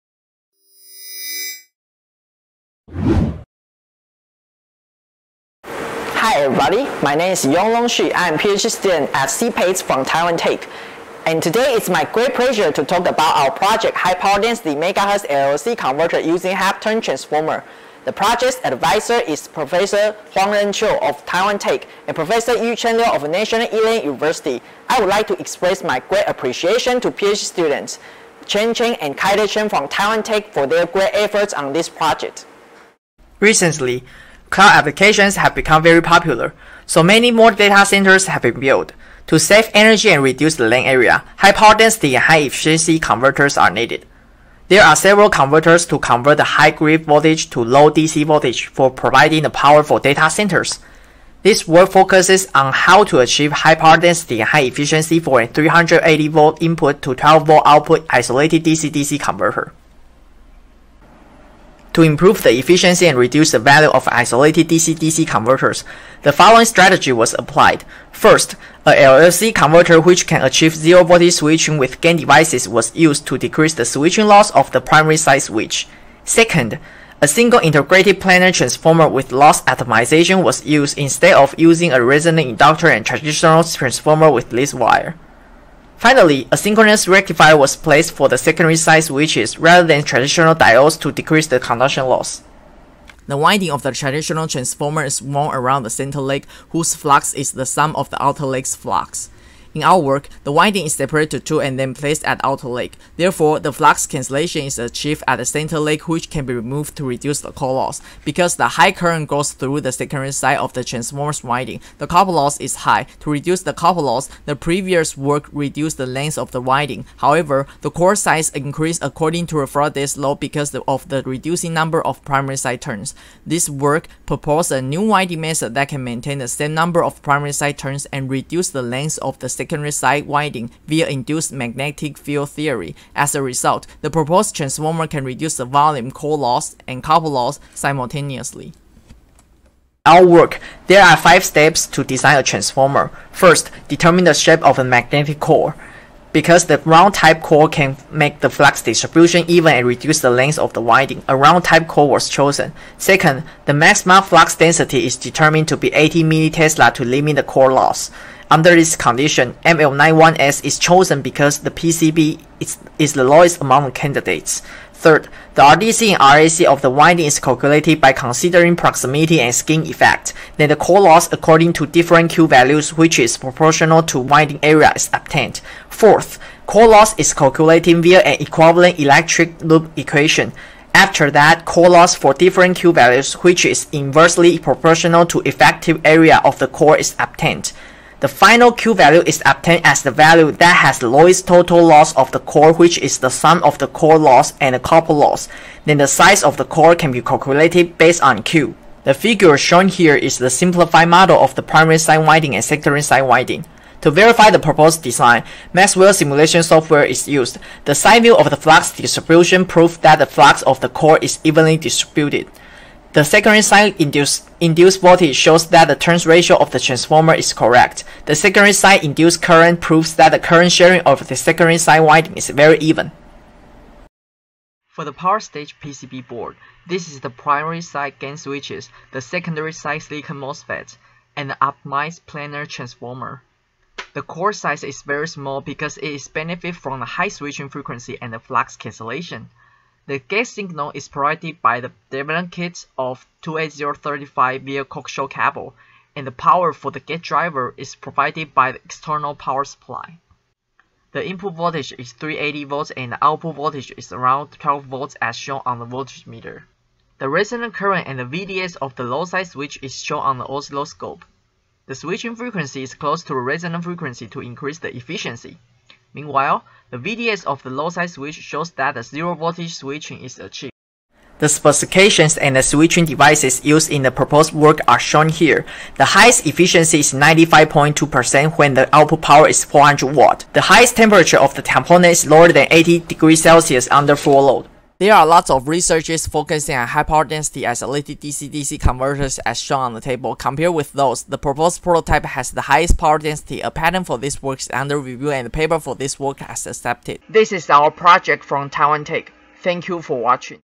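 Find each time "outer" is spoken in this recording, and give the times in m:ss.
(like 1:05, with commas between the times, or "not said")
1:38, 1:42.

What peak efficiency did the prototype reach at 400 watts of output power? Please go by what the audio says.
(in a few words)
95.2%.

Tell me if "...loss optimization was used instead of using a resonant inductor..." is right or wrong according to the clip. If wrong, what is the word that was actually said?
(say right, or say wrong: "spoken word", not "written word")
right.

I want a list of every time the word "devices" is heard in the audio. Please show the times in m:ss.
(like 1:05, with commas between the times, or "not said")
1:12, 4:33.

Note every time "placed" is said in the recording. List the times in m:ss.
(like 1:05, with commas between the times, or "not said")
1:27, 1:41.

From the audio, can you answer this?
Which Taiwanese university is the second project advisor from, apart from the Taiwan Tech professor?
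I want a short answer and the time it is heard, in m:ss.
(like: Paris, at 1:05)
National Ilan University, at 0:23.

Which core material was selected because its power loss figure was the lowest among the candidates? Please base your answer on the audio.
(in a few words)
ML91S.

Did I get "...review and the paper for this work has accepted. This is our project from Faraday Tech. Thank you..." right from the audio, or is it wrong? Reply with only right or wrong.
wrong.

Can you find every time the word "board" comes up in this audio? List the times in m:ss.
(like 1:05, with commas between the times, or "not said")
3:46.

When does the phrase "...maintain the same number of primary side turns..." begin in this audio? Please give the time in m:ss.
2:06.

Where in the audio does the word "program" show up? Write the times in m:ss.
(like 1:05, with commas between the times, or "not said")
not said.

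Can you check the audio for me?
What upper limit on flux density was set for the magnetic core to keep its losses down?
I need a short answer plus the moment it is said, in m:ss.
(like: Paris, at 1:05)
80 mT, at 2:35.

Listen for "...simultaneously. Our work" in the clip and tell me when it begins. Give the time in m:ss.
2:17.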